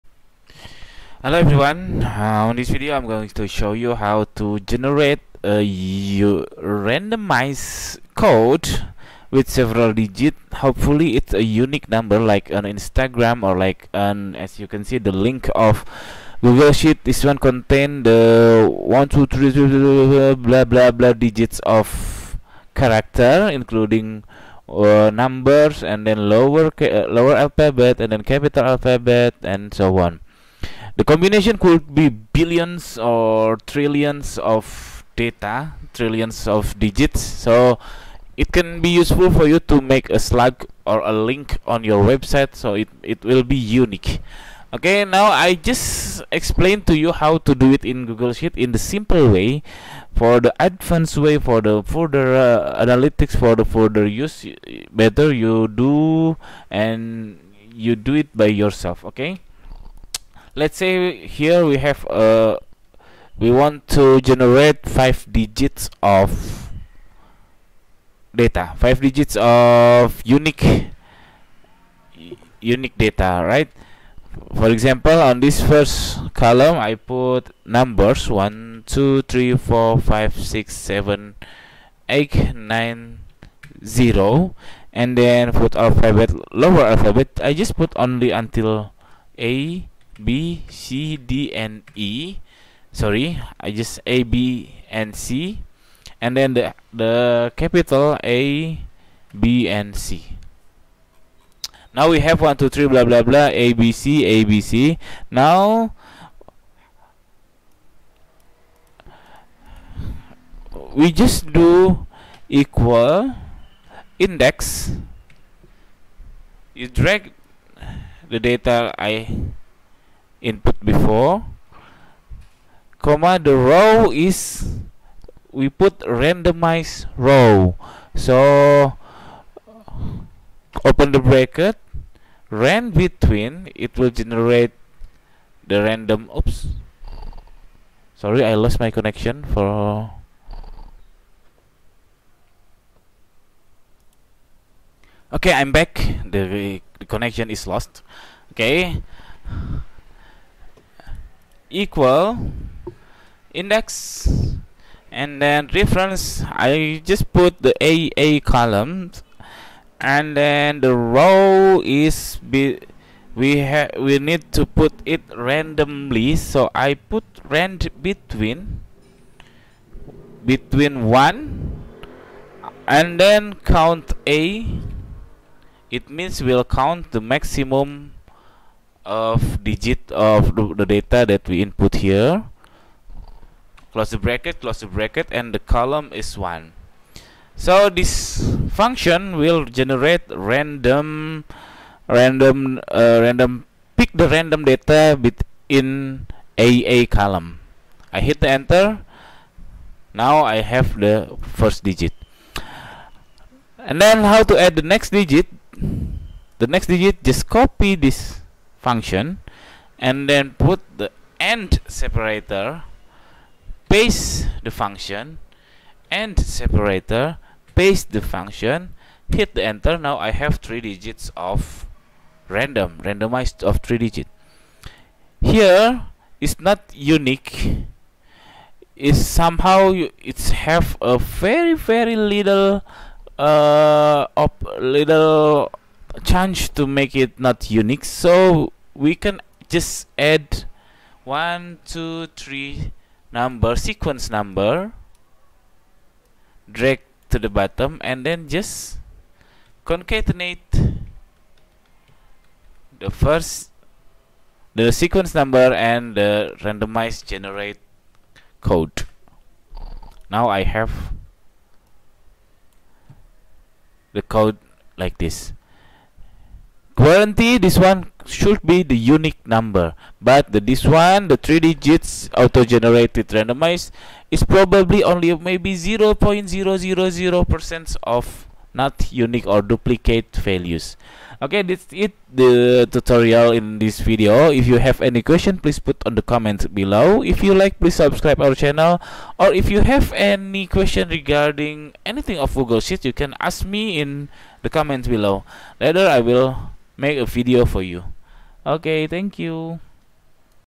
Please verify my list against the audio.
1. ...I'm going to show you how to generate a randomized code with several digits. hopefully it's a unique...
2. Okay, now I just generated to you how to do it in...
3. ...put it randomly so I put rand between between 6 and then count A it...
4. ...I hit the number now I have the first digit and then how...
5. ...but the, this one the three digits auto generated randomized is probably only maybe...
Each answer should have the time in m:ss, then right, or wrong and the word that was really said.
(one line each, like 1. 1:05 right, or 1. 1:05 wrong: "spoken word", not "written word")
1. 0:02 right
2. 0:44 wrong: "explained", not "generated"
3. 2:44 wrong: "1", not "6"
4. 3:18 wrong: "enter", not "number"
5. 4:30 right.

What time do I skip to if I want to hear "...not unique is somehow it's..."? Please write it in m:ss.
3:46.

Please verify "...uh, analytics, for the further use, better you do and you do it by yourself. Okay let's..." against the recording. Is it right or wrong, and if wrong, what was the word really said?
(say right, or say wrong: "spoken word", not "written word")
right.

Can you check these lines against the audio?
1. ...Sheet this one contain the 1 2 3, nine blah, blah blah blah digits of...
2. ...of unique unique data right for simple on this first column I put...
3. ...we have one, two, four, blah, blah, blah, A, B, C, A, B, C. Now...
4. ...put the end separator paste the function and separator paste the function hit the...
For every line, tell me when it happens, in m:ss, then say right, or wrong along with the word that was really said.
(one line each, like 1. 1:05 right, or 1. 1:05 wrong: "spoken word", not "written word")
1. 0:16 wrong: "three", not "nine"
2. 1:09 wrong: "example", not "simple"
3. 1:42 wrong: "three", not "four"
4. 3:30 right.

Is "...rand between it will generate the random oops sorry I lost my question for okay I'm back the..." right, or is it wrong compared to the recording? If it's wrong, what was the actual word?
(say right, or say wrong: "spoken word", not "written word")
wrong: "connection", not "question".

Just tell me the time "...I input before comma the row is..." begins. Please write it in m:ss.
1:58.